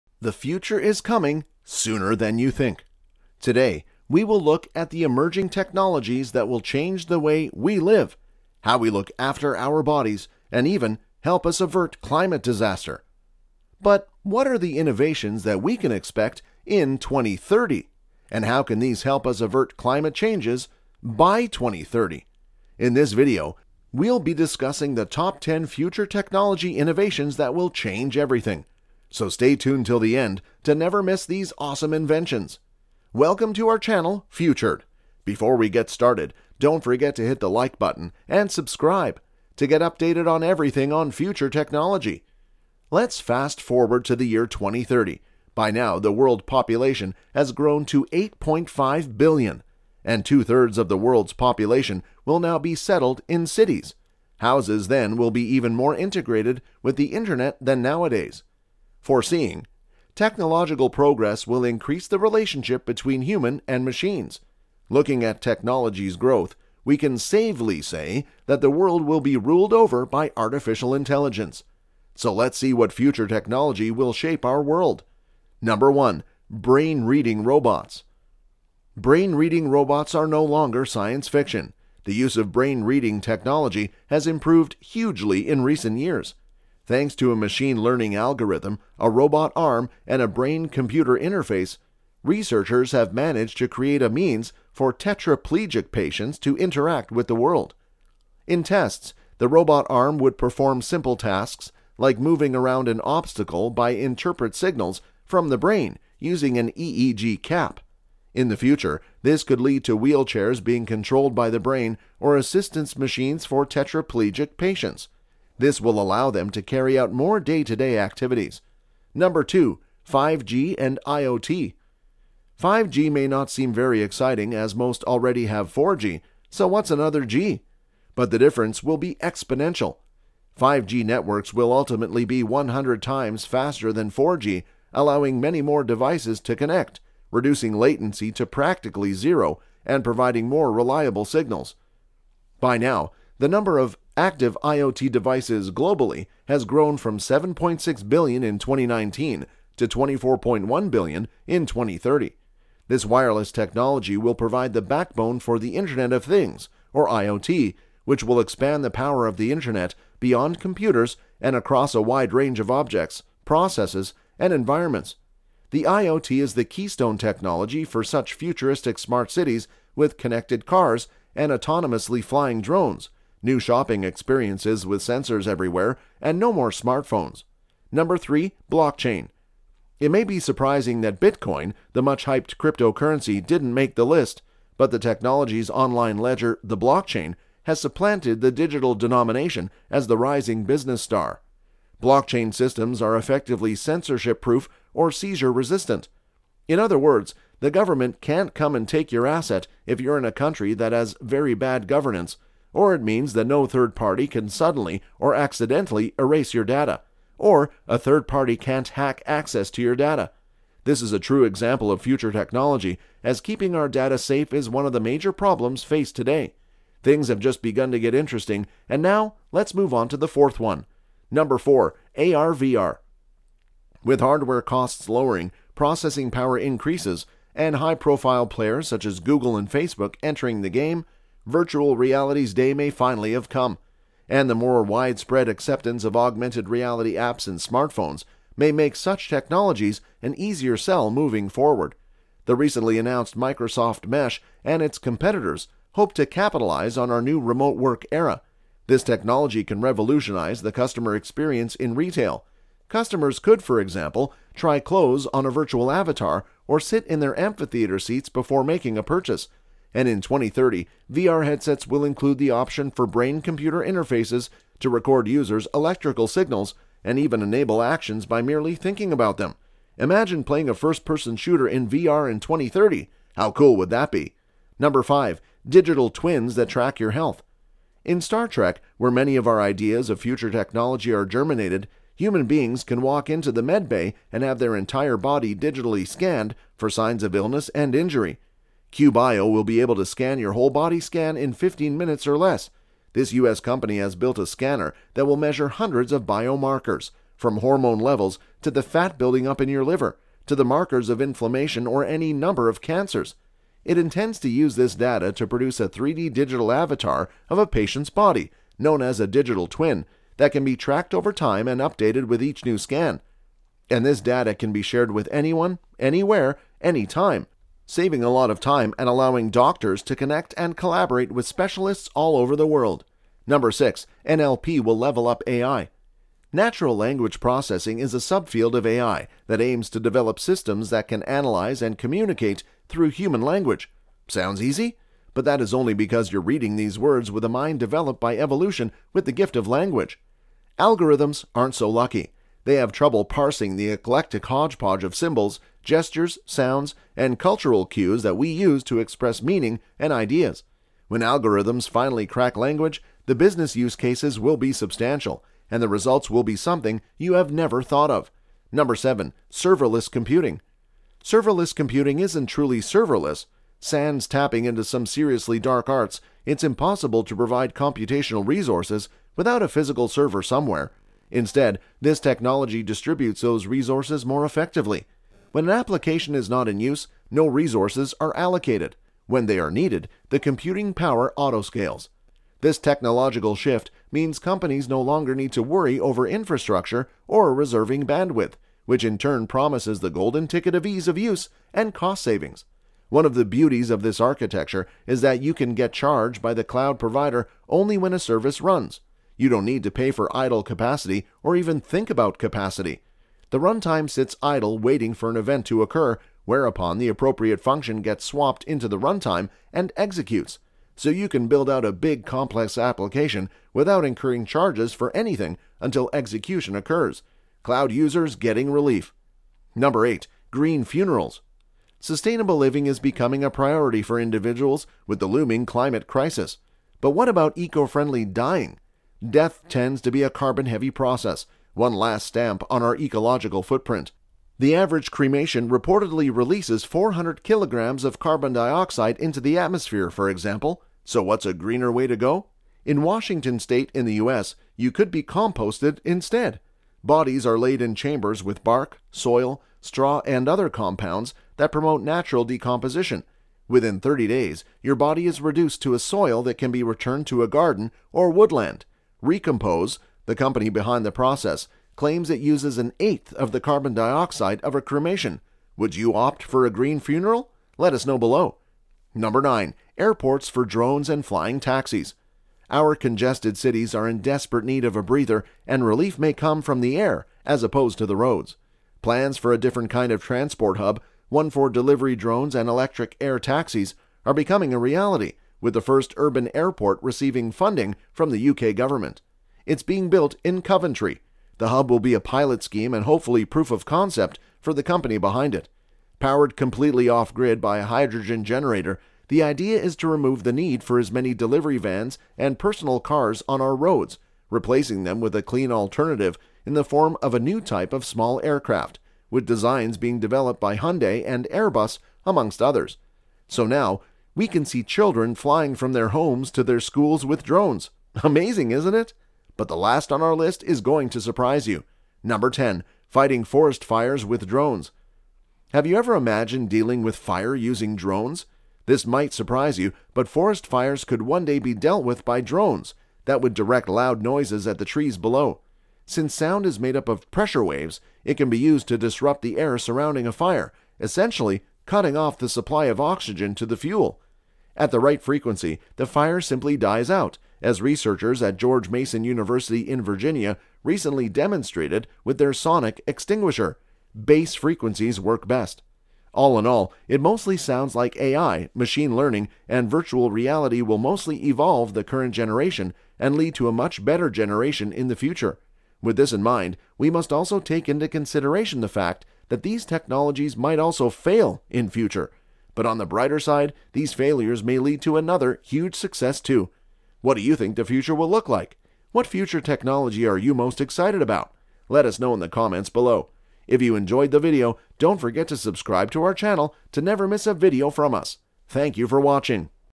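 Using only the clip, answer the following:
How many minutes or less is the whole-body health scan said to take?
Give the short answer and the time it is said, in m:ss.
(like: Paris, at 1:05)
15 minutes, at 4:51.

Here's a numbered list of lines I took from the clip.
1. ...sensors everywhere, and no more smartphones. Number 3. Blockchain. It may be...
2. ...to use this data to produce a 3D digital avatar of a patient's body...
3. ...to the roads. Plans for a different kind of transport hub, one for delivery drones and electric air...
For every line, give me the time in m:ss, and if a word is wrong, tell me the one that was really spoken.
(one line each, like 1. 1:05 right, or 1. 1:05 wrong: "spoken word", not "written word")
1. 2:55 right
2. 5:04 right
3. 7:57 right.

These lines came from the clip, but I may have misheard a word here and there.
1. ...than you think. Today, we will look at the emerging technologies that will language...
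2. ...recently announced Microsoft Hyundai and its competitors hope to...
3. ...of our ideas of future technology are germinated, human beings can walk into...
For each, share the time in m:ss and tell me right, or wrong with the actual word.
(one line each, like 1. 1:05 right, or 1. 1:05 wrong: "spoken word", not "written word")
1. 0:02 wrong: "change", not "language"
2. 4:02 wrong: "Mesh", not "Hyundai"
3. 4:39 right.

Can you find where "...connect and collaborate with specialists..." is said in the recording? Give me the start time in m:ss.
5:20.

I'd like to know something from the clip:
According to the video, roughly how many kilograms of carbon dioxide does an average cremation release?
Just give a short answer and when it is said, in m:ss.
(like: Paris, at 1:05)
400 kilograms, at 7:16.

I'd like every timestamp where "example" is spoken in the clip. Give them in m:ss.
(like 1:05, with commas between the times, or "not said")
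3:31, 4:13, 7:20.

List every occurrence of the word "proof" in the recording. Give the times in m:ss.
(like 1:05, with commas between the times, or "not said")
3:14, 8:13.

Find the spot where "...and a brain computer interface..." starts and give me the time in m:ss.
1:30.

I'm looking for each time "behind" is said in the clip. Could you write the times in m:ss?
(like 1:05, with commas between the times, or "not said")
7:40, 8:15.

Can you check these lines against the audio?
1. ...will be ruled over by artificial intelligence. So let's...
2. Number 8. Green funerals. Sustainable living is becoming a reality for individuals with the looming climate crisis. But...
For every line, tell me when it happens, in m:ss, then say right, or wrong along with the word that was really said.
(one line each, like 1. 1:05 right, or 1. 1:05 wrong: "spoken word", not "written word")
1. 1:09 right
2. 6:59 wrong: "priority", not "reality".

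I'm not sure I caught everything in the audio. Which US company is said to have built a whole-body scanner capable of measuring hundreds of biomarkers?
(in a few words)
QBio.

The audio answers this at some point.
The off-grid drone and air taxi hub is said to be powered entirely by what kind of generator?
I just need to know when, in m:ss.
8:17.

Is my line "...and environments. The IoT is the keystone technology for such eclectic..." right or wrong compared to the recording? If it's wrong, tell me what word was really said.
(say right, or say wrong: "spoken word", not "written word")
wrong: "futuristic", not "eclectic".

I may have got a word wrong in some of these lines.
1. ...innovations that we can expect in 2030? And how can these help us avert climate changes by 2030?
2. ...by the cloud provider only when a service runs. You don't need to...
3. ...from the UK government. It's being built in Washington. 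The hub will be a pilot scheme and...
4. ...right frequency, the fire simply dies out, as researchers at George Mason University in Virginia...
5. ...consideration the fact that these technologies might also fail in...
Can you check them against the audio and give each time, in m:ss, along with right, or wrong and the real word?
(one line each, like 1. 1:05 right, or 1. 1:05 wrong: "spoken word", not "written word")
1. 0:14 right
2. 6:36 right
3. 8:08 wrong: "Coventry", not "Washington"
4. 9:04 right
5. 9:28 right.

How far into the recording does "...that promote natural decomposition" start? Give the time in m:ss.
7:31.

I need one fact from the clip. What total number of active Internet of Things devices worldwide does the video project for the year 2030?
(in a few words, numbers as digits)
24.1 billion.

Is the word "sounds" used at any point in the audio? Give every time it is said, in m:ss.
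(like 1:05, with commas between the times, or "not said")
5:34, 5:46, 8:56, 9:17.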